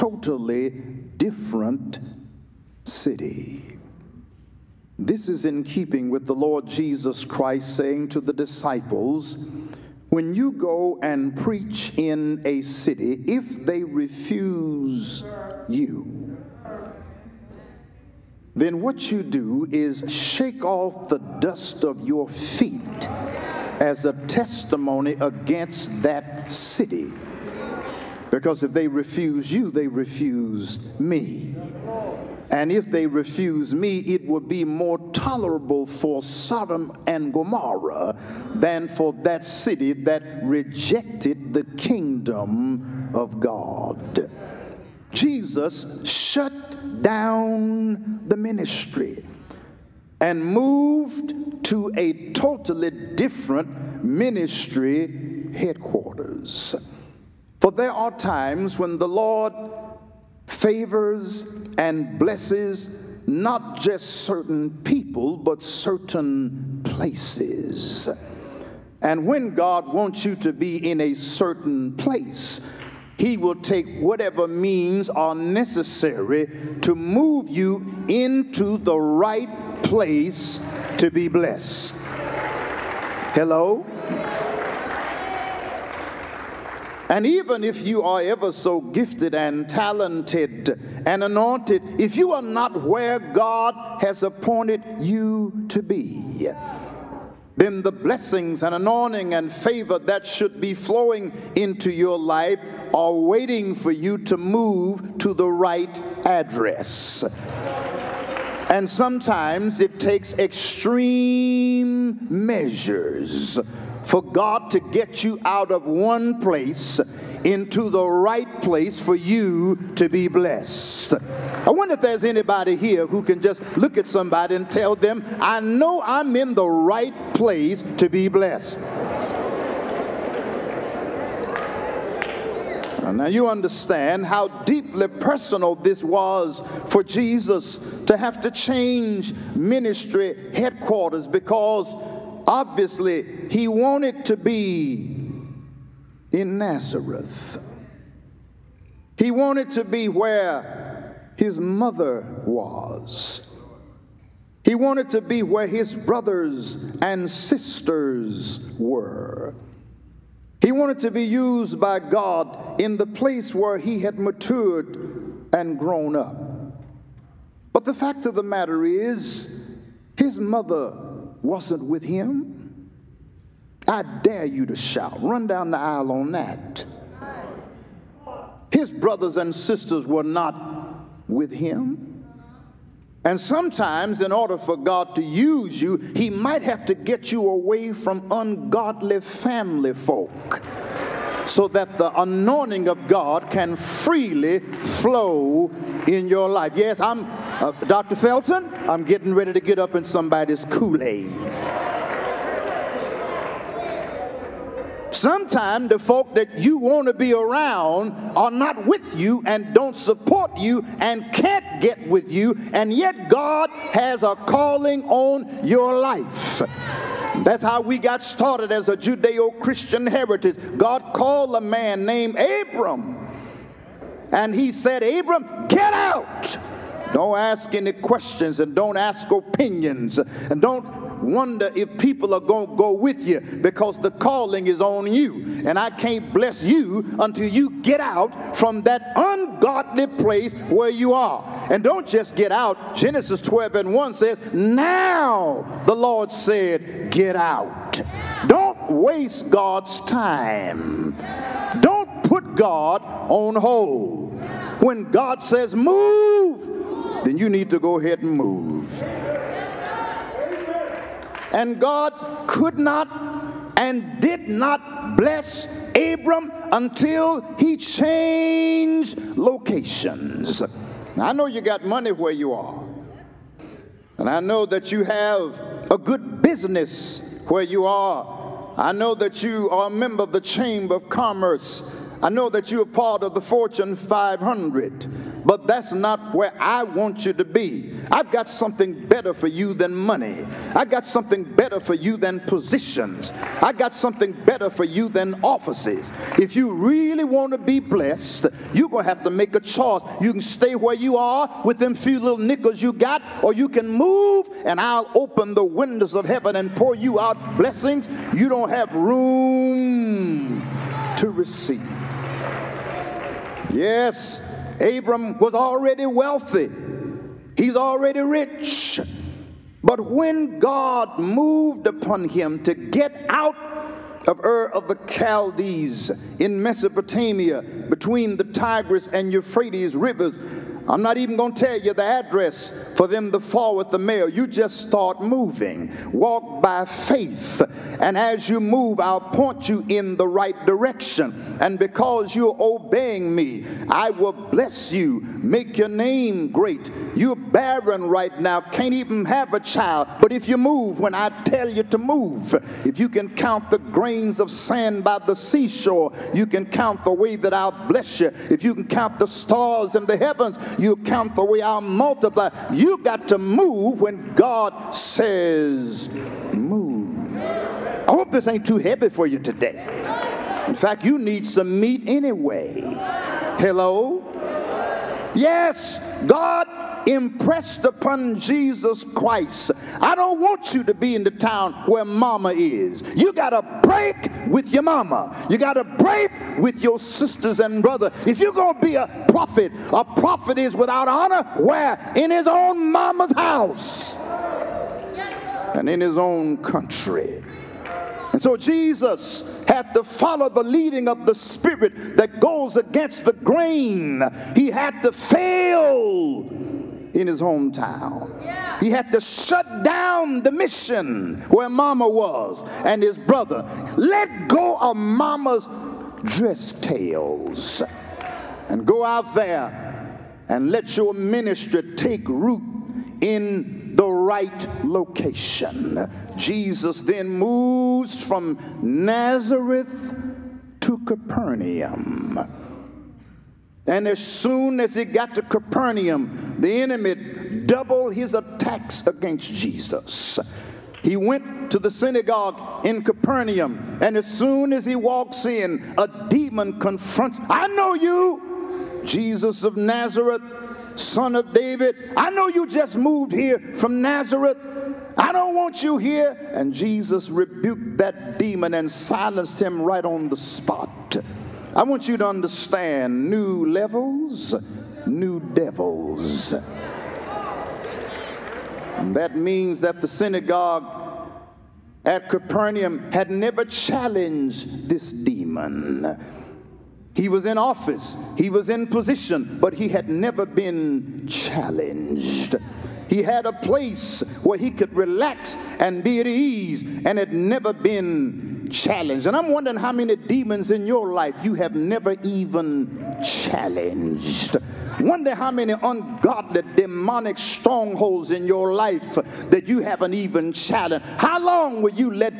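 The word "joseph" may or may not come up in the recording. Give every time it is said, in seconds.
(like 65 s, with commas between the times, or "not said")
not said.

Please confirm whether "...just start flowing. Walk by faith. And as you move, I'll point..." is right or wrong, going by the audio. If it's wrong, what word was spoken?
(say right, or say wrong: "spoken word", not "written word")
wrong: "moving", not "flowing".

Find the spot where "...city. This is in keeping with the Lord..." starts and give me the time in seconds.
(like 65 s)
2 s.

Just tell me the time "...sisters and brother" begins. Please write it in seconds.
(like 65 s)
386 s.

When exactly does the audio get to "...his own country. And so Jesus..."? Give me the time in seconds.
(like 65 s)
396 s.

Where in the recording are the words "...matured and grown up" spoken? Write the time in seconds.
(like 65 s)
164 s.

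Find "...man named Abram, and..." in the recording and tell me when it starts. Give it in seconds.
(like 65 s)
221 s.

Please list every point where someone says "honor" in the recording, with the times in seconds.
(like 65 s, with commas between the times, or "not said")
391 s.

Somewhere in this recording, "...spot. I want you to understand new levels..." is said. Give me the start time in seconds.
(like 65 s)
460 s.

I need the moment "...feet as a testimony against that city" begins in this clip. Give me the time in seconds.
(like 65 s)
22 s.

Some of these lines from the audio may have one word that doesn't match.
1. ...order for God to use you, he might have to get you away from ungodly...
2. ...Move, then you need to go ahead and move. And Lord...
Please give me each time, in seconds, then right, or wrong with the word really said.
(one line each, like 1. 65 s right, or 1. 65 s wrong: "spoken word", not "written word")
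1. 184 s right
2. 255 s wrong: "God", not "Lord".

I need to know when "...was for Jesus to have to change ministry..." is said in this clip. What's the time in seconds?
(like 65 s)
136 s.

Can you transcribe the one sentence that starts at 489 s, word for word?
And I'm wondering how many demons in your life you have never even challenged.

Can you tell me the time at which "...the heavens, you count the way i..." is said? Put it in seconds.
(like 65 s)
360 s.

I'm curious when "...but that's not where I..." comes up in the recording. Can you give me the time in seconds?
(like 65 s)
285 s.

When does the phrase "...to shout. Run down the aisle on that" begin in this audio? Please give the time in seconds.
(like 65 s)
174 s.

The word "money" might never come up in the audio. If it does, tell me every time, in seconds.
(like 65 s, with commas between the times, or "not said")
271 s, 289 s.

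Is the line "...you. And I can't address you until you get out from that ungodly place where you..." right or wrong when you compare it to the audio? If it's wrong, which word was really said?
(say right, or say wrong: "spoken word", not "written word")
wrong: "bless", not "address".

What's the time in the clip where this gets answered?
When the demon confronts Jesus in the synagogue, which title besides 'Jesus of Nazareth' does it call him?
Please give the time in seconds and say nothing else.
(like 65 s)
450 s.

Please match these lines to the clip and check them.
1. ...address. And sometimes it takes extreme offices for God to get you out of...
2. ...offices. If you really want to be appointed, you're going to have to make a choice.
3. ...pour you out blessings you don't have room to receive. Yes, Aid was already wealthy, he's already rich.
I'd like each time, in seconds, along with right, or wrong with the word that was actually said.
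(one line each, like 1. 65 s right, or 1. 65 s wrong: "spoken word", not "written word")
1. 106 s wrong: "measures", not "offices"
2. 295 s wrong: "blessed", not "appointed"
3. 306 s wrong: "Abram", not "Aid".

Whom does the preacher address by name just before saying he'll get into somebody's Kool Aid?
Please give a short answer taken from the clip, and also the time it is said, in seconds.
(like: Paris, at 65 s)
Dr. Felton, at 197 s.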